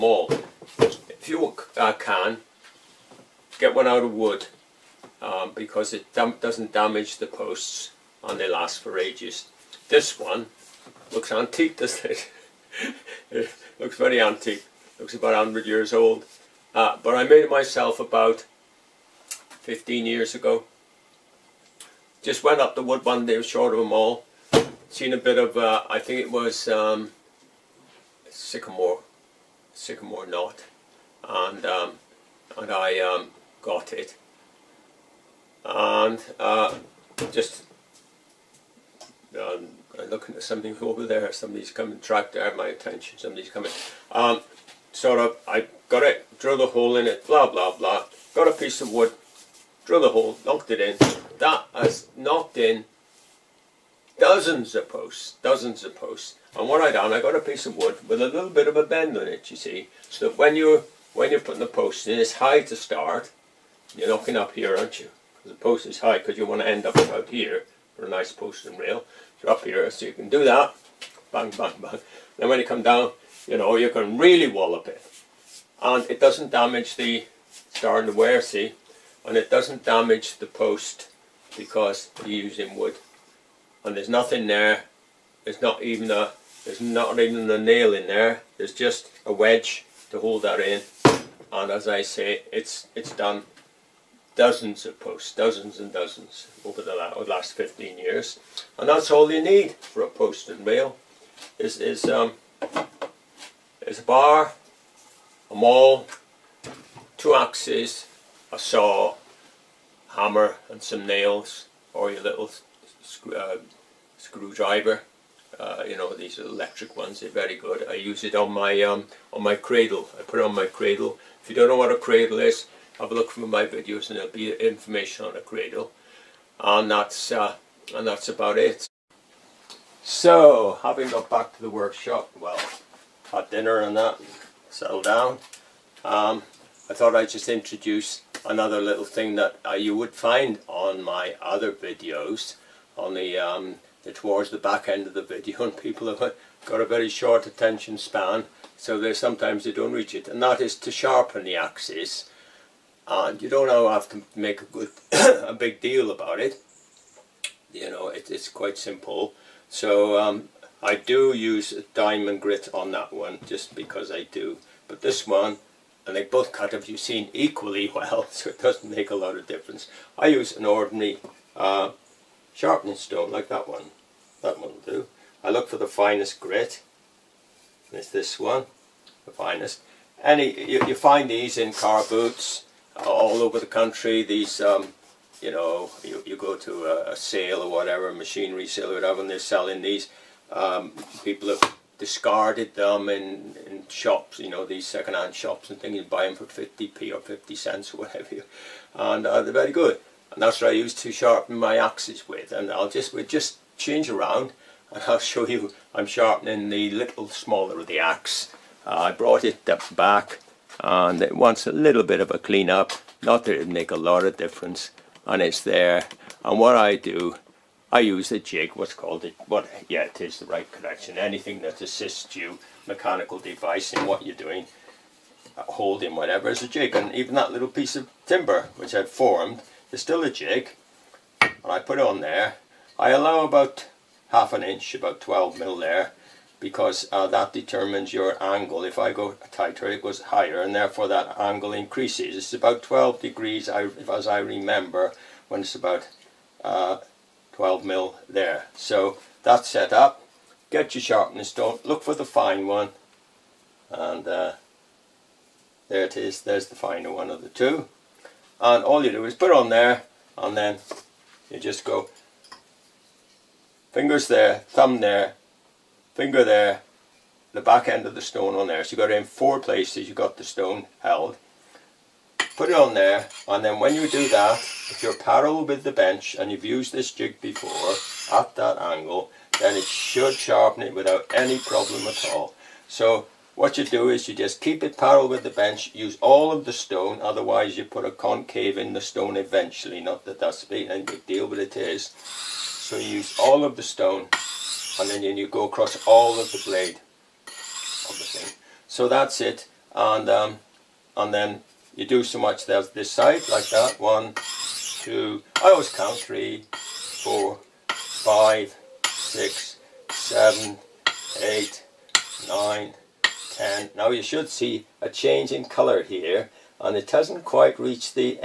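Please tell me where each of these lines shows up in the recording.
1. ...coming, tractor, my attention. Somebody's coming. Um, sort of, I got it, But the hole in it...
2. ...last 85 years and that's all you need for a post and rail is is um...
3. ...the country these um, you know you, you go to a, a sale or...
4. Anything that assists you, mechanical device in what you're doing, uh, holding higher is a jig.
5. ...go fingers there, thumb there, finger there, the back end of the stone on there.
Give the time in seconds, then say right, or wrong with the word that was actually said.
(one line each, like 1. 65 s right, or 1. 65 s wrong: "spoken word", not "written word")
1. 41 s wrong: "Drill", not "But"
2. 97 s wrong: "15", not "85"
3. 183 s right
4. 221 s wrong: "whatever", not "higher"
5. 261 s right.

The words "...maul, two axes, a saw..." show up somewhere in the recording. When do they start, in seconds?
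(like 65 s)
105 s.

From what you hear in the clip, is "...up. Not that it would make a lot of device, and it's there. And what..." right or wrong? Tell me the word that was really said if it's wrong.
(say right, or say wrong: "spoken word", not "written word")
wrong: "difference", not "device".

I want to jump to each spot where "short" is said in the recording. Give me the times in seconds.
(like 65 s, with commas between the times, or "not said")
23 s, 147 s.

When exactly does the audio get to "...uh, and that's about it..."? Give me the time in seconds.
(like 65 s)
127 s.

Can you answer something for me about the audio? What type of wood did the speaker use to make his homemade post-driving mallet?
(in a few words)
sycamore knot.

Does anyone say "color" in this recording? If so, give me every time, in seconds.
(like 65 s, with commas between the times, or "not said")
315 s.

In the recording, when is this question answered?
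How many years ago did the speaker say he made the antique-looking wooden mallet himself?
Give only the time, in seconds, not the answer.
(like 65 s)
17 s.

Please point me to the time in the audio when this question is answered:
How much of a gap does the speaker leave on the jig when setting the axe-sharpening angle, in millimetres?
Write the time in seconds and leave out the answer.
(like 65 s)
234 s.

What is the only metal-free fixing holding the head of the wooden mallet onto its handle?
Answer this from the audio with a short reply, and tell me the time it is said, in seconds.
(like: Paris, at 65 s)
a wedge, at 88 s.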